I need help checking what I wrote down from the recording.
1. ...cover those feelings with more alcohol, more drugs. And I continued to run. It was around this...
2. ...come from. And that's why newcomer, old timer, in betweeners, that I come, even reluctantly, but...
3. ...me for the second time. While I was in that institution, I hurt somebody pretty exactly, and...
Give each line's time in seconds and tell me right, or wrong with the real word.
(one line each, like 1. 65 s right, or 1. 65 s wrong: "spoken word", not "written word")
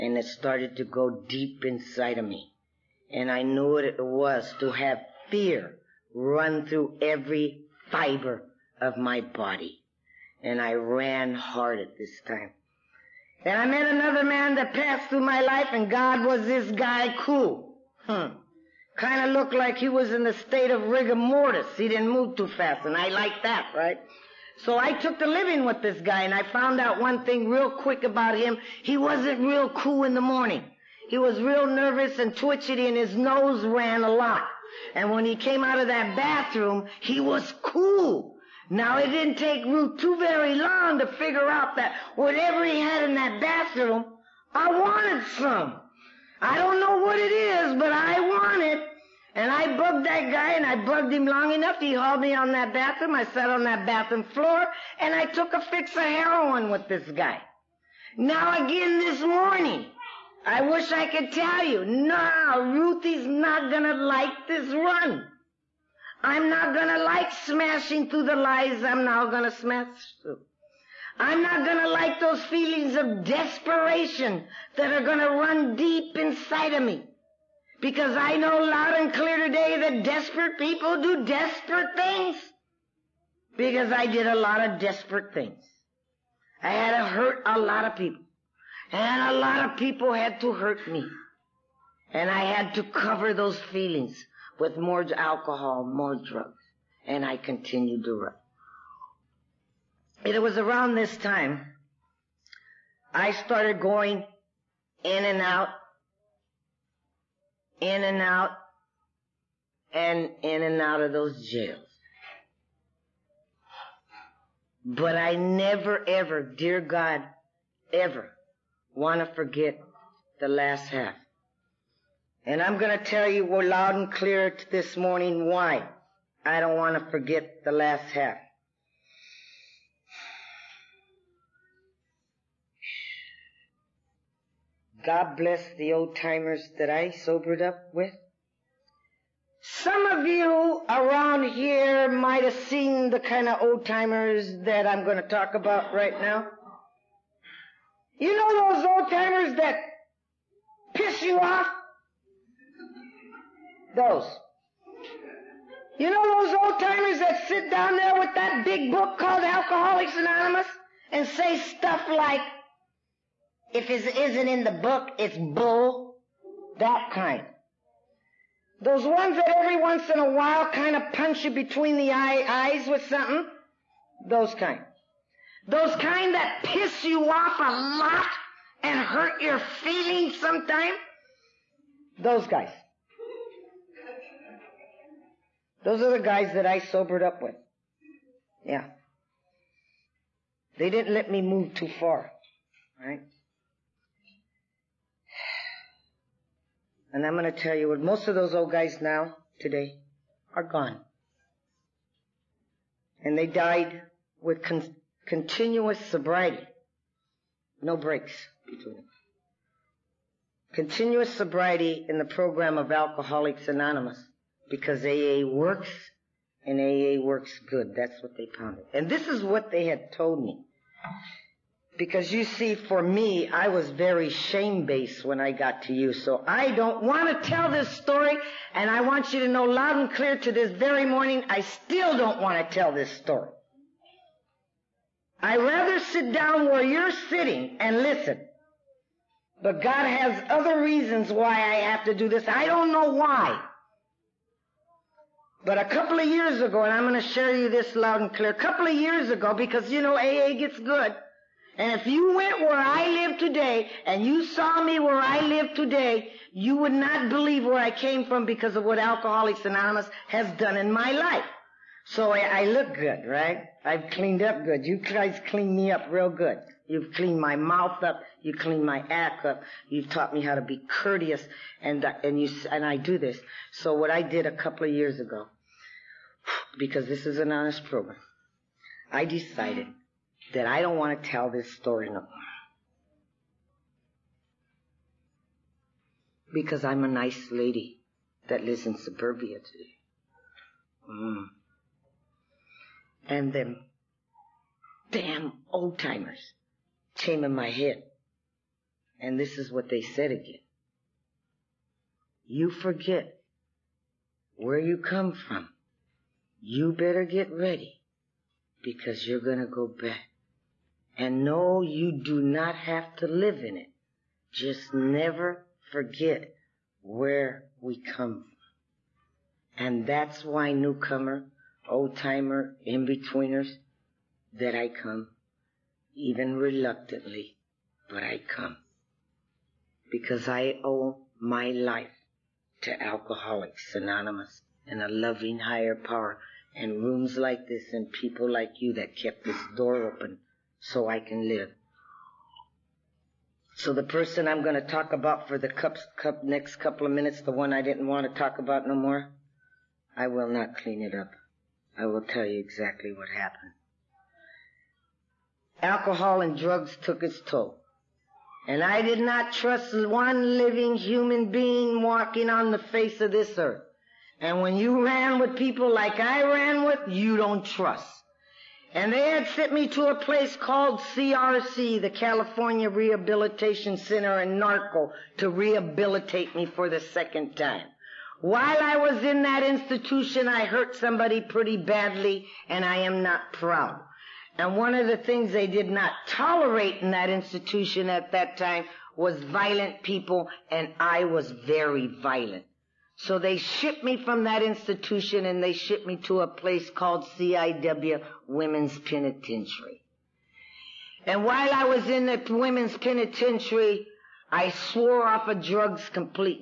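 1. 92 s right
2. 318 s right
3. 376 s wrong: "badly", not "exactly".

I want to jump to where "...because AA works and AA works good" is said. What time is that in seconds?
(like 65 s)
214 s.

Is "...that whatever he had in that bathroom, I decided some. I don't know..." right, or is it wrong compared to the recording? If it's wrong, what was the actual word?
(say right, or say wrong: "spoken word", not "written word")
wrong: "wanted", not "decided".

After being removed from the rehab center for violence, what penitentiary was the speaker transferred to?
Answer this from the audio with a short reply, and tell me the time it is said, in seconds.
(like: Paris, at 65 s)
CIW Women's Penitentiary, at 397 s.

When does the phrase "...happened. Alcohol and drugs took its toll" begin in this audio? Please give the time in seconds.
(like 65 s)
353 s.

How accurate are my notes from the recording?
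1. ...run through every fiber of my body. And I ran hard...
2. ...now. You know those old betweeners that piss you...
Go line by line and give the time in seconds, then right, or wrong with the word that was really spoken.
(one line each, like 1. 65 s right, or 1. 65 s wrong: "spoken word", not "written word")
1. 6 s right
2. 146 s wrong: "timers", not "betweeners".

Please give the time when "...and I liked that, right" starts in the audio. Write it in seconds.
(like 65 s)
22 s.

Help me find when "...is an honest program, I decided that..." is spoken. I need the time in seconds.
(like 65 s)
277 s.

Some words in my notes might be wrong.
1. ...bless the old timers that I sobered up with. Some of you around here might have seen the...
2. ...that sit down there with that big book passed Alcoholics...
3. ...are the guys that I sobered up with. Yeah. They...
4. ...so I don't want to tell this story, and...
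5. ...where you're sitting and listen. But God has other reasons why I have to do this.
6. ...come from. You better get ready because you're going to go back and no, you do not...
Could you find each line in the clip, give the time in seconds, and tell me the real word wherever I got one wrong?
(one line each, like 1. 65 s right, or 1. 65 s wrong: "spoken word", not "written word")
1. 135 s right
2. 157 s wrong: "called", not "passed"
3. 186 s right
4. 226 s right
5. 236 s right
6. 304 s right.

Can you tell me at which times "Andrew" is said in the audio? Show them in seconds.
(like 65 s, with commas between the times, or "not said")
not said.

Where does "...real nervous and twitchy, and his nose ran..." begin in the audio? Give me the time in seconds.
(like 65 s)
31 s.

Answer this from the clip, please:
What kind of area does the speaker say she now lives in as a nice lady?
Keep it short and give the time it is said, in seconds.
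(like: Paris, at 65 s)
suburbia, at 288 s.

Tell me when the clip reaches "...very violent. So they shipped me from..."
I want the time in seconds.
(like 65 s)
391 s.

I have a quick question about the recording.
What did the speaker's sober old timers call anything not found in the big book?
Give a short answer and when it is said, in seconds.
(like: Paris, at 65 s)
bull, at 165 s.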